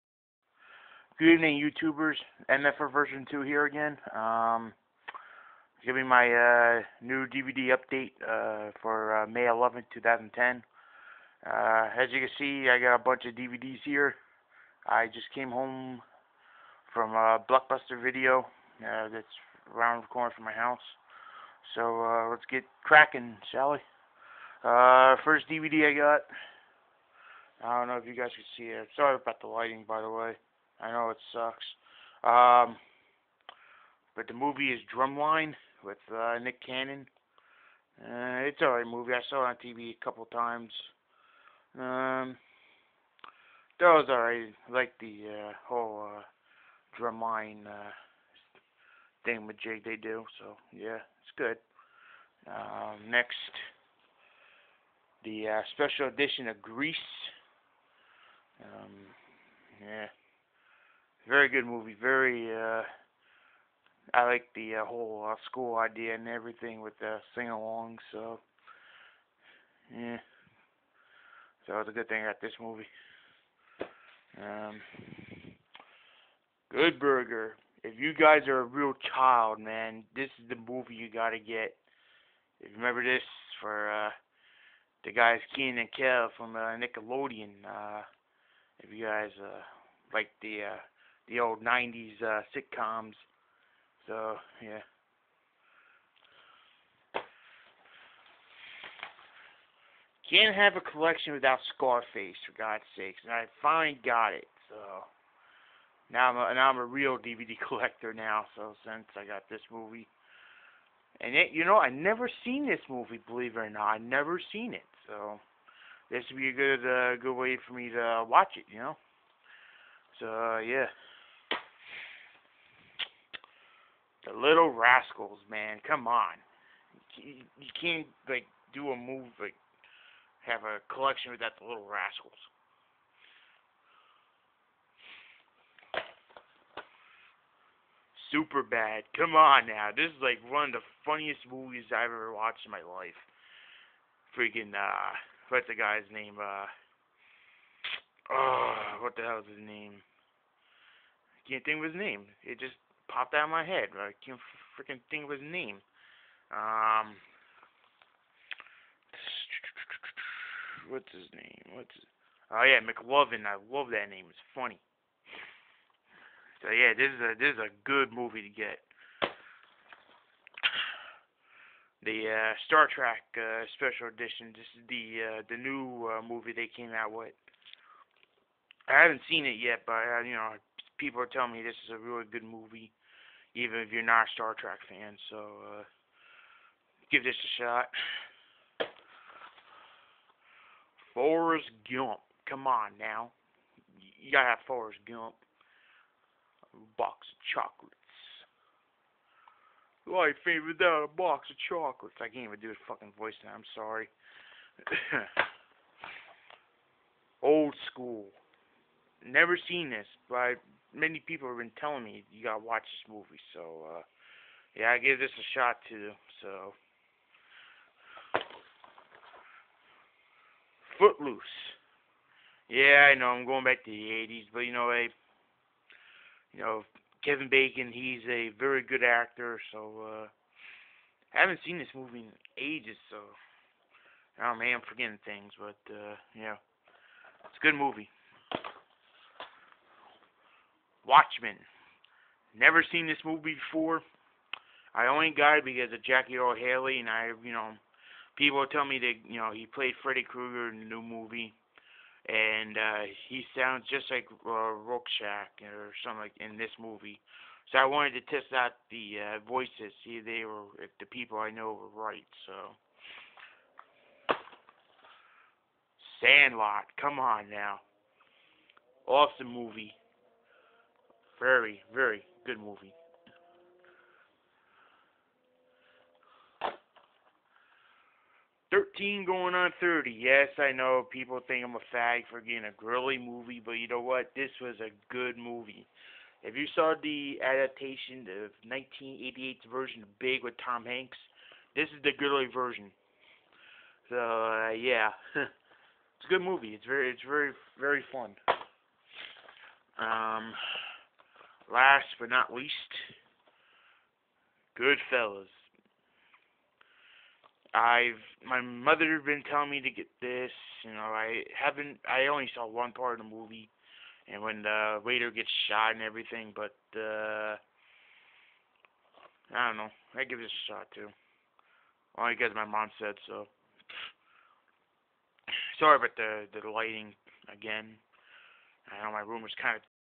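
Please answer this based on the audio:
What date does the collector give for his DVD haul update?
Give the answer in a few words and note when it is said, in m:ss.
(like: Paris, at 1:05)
May 11, 2010, at 0:09.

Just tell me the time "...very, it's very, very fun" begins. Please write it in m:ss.
4:56.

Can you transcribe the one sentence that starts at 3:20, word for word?
Life ain't without a box of chocolates.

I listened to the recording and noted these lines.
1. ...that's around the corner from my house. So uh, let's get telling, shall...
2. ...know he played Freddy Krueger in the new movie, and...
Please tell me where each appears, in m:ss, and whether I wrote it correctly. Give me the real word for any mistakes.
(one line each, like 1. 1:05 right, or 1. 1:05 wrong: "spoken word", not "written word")
1. 0:19 wrong: "cracking", not "telling"
2. 4:09 right.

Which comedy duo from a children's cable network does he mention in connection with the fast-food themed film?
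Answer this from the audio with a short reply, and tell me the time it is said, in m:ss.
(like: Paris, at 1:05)
Kenan and Kel, at 1:25.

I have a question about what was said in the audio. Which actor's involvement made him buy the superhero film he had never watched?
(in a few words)
Jackie Earle Haley.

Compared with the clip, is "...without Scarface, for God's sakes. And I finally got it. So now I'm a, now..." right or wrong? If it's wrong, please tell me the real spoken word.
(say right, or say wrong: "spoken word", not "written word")
right.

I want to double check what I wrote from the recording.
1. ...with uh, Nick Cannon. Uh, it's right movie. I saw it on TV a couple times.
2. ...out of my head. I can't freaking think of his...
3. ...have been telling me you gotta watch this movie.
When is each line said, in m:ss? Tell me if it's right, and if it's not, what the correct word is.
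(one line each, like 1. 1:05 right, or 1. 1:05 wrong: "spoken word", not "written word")
1. 0:35 right
2. 2:33 right
3. 3:31 right.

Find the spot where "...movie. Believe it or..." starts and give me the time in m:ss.
1:52.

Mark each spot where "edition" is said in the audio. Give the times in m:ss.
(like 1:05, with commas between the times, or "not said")
0:56, 2:54.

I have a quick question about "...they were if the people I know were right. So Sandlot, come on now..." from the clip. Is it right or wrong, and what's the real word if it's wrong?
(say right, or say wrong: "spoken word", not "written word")
right.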